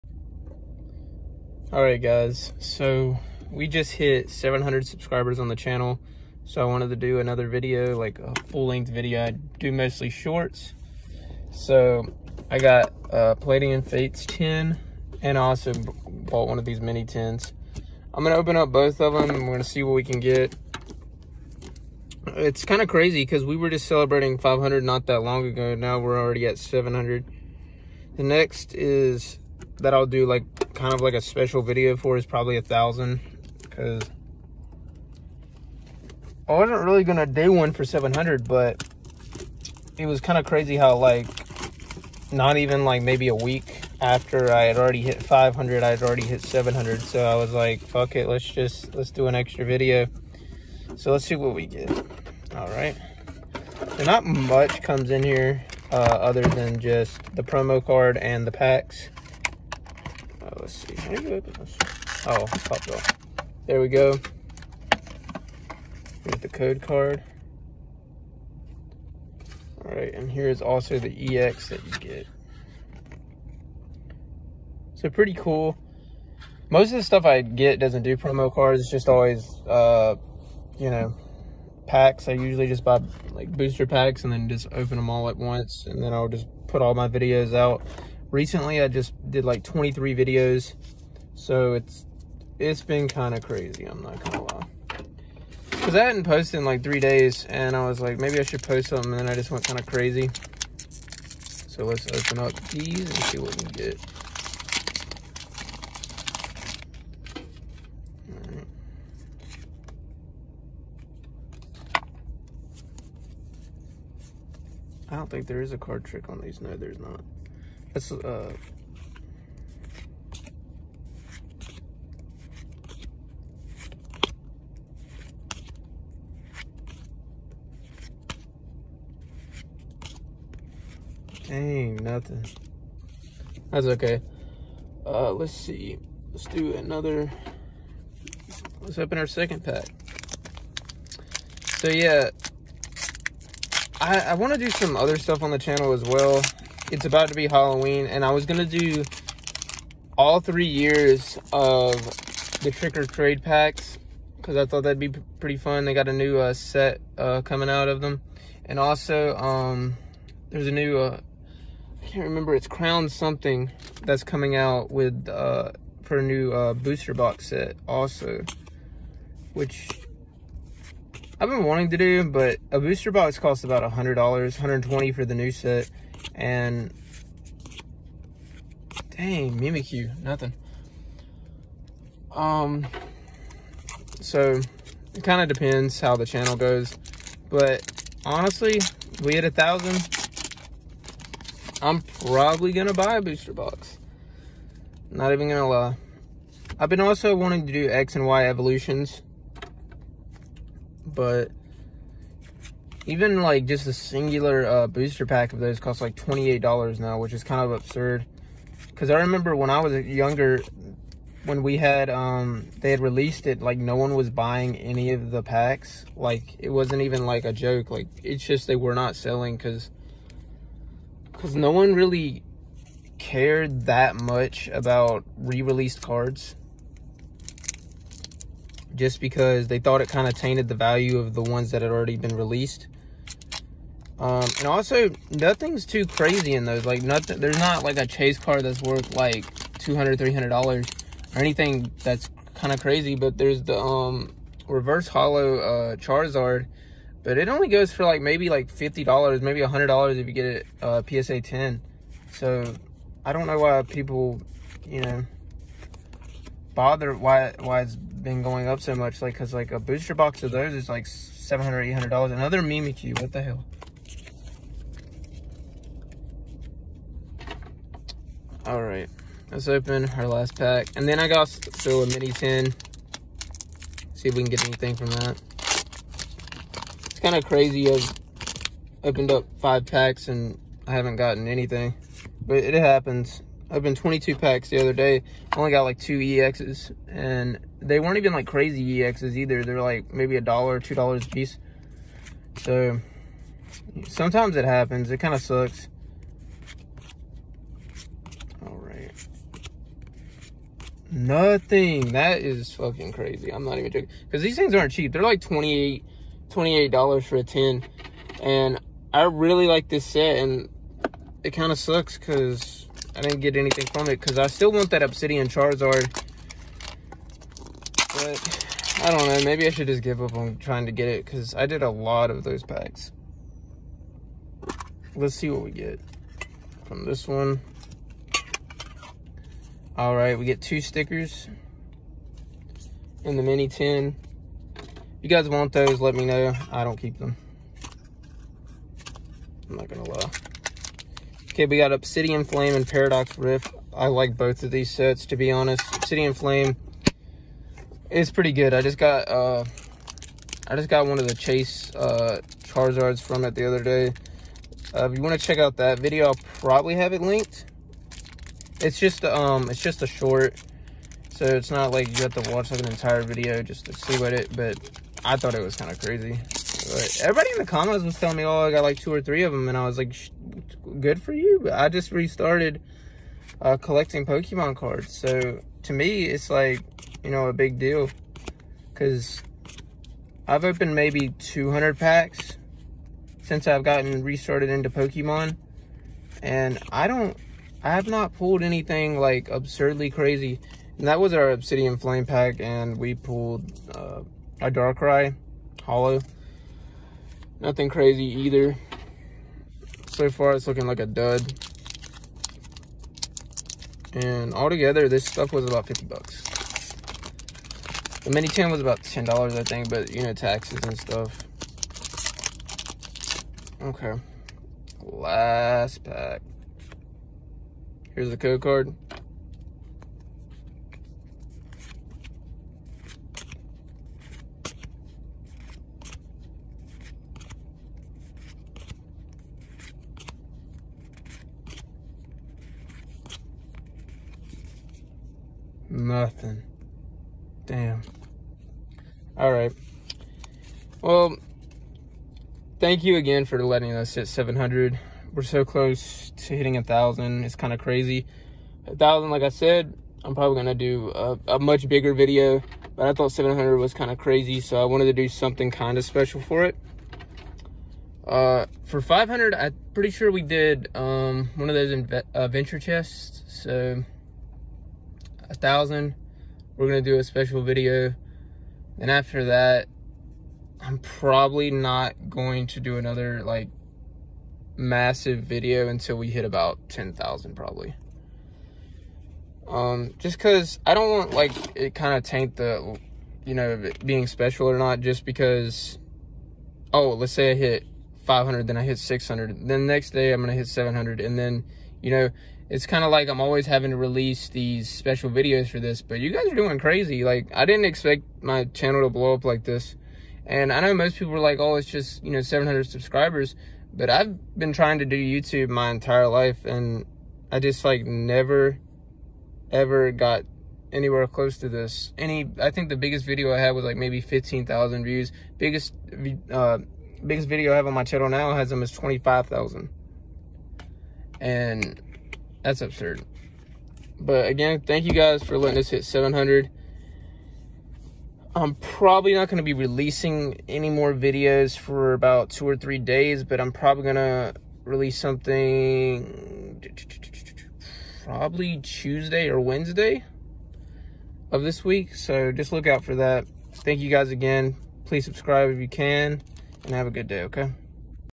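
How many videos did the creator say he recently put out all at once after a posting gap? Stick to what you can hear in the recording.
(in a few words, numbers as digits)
23.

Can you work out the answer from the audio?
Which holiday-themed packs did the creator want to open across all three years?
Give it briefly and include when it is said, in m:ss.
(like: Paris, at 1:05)
Trick or Trade, at 2:32.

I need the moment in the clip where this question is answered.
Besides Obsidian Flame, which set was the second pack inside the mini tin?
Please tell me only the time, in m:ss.
5:42.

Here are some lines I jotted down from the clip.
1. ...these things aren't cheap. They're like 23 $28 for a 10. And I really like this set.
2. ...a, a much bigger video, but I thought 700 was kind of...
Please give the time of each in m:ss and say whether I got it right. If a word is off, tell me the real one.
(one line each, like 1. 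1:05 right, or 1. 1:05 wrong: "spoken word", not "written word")
1. 5:04 wrong: "28", not "23"
2. 7:31 right.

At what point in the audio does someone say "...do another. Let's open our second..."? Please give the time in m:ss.
2:16.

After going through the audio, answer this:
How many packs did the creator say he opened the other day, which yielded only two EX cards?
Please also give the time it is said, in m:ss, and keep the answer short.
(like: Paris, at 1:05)
22, at 4:43.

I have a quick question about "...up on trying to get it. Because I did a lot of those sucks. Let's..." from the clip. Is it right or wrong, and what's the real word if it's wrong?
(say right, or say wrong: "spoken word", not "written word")
wrong: "packs", not "sucks".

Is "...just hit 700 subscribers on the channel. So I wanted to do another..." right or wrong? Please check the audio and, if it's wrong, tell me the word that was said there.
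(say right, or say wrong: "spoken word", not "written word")
right.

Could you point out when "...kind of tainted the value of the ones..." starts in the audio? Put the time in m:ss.
3:50.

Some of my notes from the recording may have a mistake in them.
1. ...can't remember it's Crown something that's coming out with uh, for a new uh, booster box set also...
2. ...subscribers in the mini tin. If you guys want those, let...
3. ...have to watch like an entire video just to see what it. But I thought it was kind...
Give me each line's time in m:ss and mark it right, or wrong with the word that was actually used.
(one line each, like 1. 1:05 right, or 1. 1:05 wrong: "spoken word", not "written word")
1. 2:42 right
2. 5:30 wrong: "stickers", not "subscribers"
3. 6:02 right.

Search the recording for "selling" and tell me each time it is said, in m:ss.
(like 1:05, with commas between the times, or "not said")
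3:39.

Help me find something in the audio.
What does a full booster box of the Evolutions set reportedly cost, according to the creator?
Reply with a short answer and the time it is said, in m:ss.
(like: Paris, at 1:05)
$700-$800, at 4:21.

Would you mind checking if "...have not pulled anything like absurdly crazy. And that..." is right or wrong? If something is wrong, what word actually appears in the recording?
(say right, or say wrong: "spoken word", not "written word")
right.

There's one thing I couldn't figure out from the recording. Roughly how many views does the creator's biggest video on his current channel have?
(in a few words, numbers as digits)
25,000.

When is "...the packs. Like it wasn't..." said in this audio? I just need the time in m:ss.
3:35.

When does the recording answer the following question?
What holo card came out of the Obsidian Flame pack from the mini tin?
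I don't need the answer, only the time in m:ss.
6:34.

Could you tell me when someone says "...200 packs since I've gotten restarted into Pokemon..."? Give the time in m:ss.
6:21.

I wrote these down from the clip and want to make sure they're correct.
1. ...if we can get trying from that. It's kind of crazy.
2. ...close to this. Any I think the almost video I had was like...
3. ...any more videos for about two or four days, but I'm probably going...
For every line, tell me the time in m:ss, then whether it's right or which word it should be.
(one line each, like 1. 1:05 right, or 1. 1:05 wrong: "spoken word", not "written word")
1. 4:34 wrong: "anything", not "trying"
2. 8:31 wrong: "biggest", not "almost"
3. 8:50 wrong: "three", not "four".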